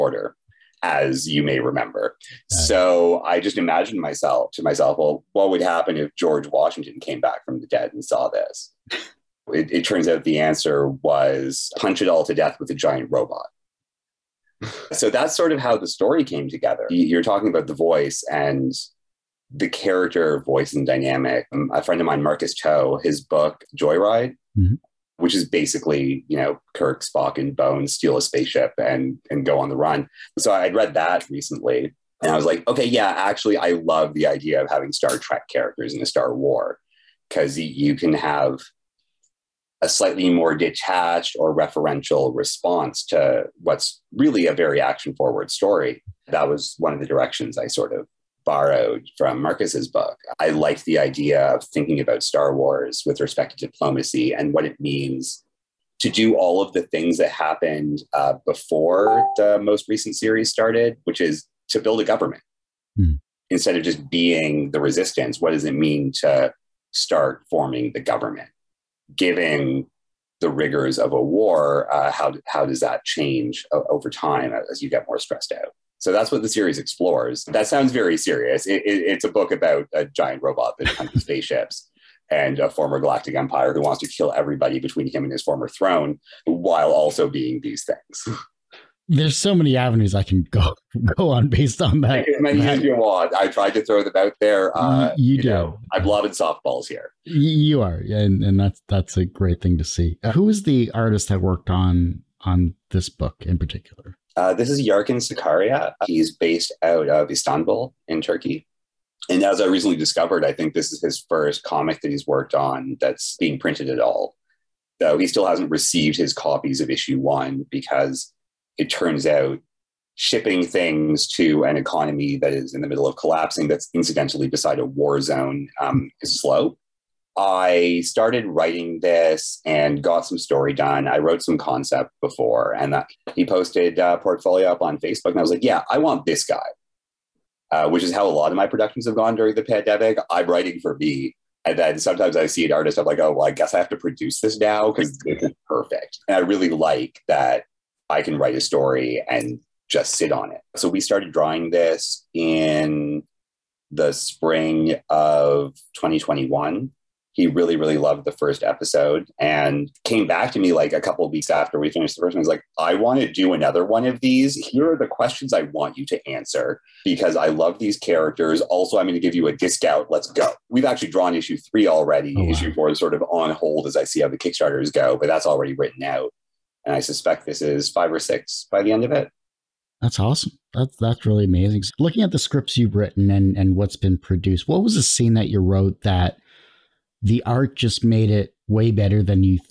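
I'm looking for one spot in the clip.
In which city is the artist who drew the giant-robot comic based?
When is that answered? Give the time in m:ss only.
1:47.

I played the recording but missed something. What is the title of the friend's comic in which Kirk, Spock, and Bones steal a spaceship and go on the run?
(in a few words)
Joyride.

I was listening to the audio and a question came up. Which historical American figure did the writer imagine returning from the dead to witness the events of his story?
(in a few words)
George Washington.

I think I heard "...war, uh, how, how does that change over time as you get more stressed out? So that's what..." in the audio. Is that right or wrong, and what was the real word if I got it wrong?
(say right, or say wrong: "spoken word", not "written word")
right.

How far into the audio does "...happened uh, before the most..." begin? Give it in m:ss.
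0:57.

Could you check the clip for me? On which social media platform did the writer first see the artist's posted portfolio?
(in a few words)
Facebook.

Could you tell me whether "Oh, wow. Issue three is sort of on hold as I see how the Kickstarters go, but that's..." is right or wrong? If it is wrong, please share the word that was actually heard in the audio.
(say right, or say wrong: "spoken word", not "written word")
wrong: "four", not "three".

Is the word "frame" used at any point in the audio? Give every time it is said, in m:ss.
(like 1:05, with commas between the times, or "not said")
not said.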